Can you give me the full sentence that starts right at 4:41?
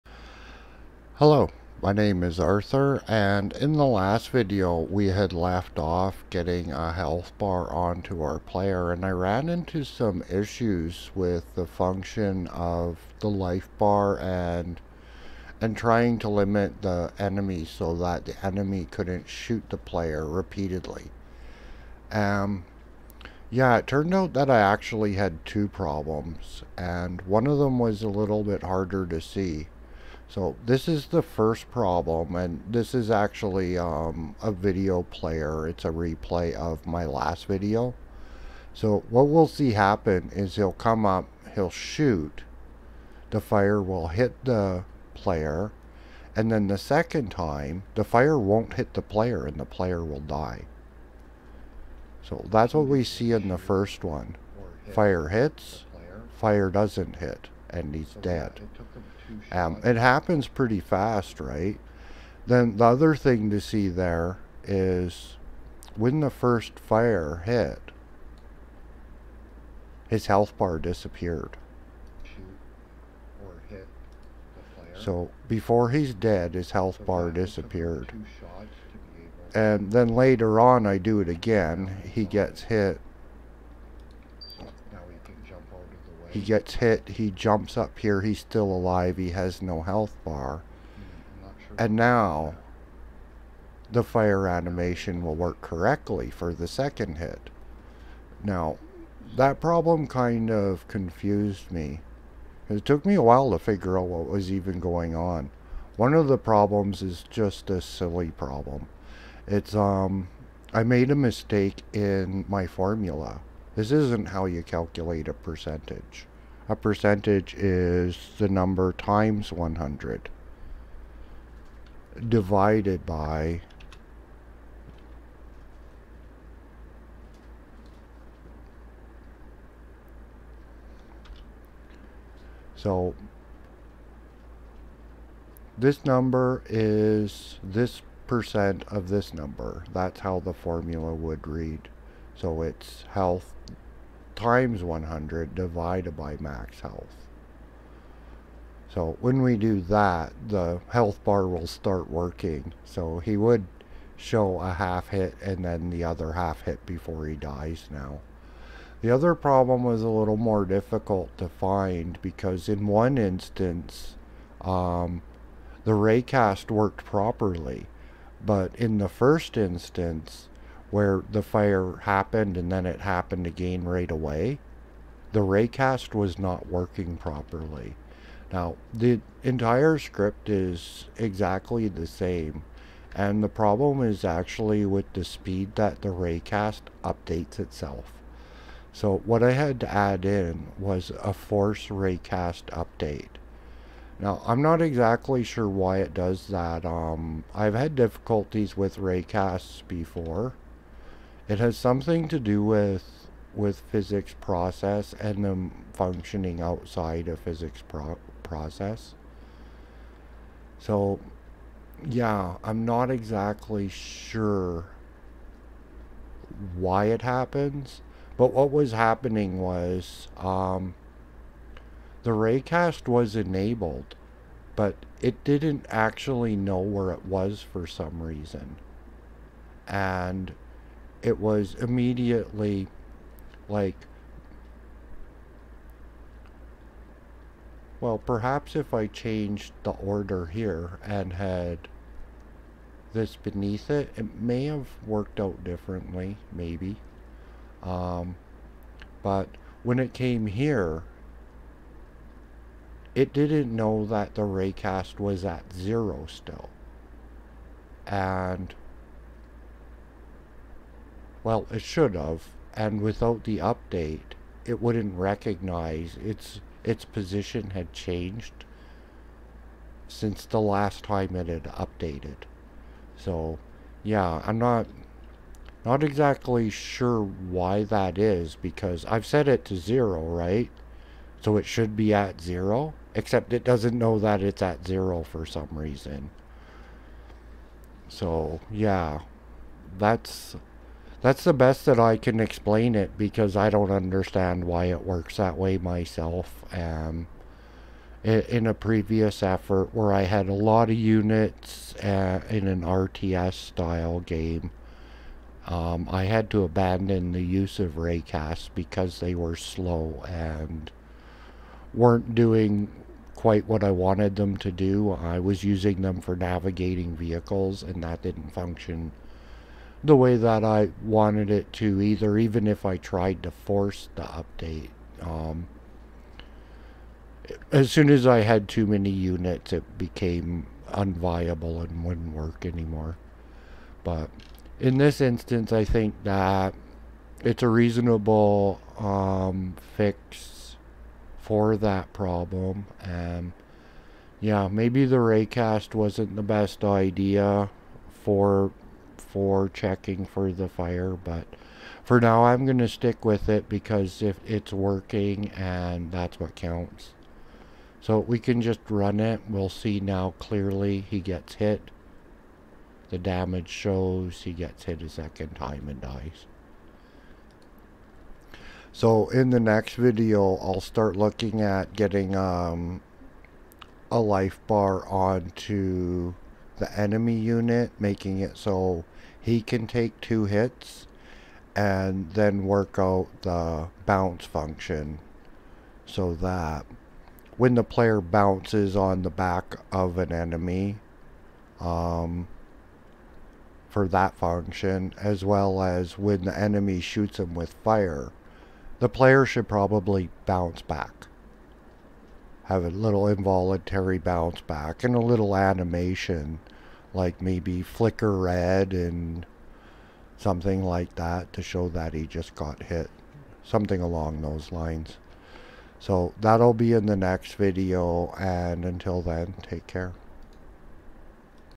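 So it should be at 0, except it doesn't know that it's at 0 for some reason.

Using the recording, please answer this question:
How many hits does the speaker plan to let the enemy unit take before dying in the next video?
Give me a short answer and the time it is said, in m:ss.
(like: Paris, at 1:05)
2, at 6:20.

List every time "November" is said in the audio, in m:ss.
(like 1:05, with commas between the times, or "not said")
not said.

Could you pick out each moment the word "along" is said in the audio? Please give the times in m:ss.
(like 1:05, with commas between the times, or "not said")
6:54.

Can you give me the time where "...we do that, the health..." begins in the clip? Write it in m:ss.
2:29.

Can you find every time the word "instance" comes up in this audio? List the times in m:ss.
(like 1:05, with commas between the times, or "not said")
2:43, 2:49, 5:35.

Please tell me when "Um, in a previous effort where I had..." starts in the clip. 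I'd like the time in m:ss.
4:56.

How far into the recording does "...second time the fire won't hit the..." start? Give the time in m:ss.
0:46.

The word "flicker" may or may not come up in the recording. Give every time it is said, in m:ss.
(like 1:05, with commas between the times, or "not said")
6:47.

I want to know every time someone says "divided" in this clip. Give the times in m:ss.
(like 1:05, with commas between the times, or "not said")
2:02, 2:25.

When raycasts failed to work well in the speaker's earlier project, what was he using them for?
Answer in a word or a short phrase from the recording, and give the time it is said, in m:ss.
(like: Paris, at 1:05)
navigating vehicles, at 5:16.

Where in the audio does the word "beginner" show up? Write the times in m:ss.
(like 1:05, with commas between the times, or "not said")
not said.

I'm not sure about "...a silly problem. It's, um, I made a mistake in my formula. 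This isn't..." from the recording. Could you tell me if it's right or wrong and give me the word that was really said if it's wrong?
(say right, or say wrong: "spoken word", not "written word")
right.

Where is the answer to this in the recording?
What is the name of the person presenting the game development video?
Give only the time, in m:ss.
0:02.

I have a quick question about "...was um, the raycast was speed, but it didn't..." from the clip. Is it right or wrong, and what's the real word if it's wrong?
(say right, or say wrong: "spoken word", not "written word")
wrong: "enabled", not "speed".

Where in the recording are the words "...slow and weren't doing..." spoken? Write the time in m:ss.
5:09.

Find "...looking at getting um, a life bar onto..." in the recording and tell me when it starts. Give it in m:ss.
6:11.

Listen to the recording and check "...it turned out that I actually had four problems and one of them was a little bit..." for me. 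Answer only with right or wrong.
wrong.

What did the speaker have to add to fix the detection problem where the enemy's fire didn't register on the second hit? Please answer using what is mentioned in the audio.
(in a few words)
force raycast update.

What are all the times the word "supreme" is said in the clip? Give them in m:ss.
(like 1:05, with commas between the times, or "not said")
not said.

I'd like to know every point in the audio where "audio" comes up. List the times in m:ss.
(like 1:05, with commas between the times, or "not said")
not said.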